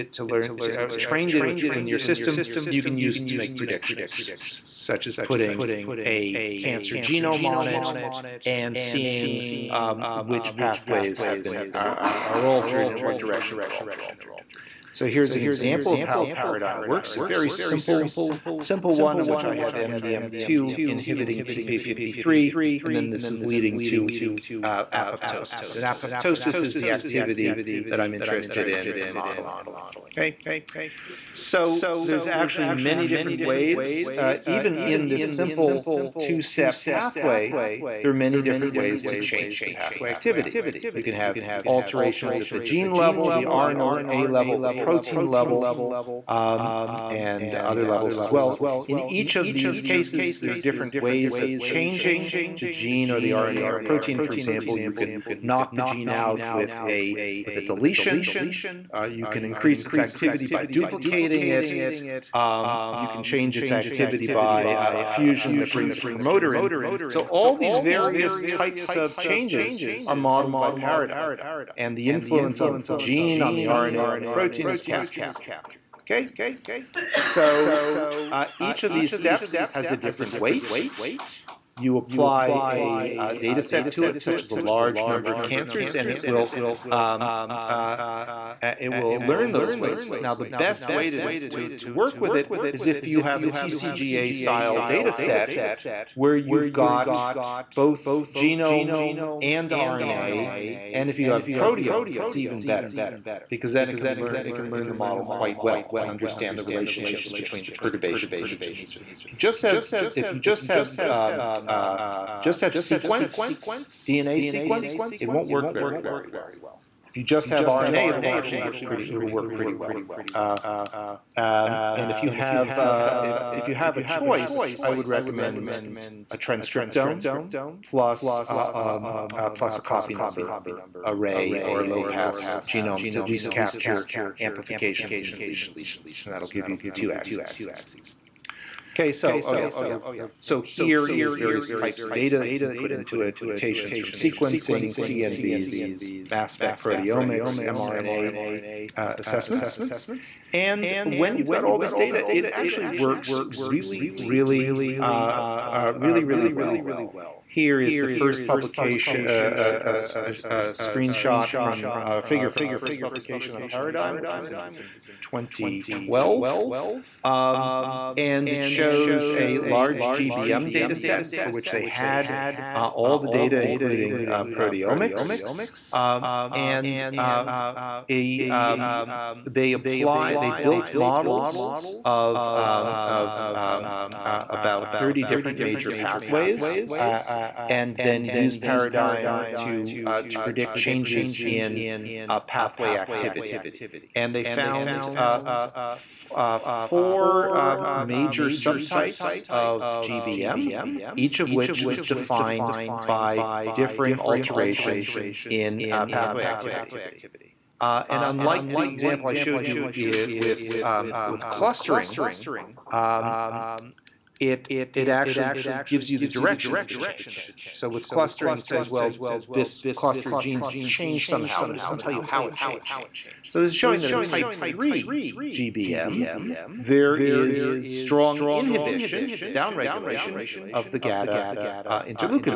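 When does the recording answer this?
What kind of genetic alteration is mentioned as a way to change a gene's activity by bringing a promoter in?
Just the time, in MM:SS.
01:04.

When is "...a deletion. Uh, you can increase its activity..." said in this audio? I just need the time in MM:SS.
00:57.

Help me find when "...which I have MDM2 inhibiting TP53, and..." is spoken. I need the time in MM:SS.
00:19.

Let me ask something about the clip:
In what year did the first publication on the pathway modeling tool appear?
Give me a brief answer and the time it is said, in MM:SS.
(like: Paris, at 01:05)
2012, at 02:45.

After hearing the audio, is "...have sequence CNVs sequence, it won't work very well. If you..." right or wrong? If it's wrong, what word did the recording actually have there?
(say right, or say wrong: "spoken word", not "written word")
wrong: "DNA", not "CNVs".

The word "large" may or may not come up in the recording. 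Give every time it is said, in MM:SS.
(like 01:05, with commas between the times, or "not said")
01:24, 02:49.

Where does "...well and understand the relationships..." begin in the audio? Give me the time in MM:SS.
01:45.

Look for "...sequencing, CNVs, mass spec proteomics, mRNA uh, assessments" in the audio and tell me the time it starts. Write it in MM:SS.
02:24.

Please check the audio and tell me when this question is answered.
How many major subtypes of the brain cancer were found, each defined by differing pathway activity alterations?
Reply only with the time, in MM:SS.
03:16.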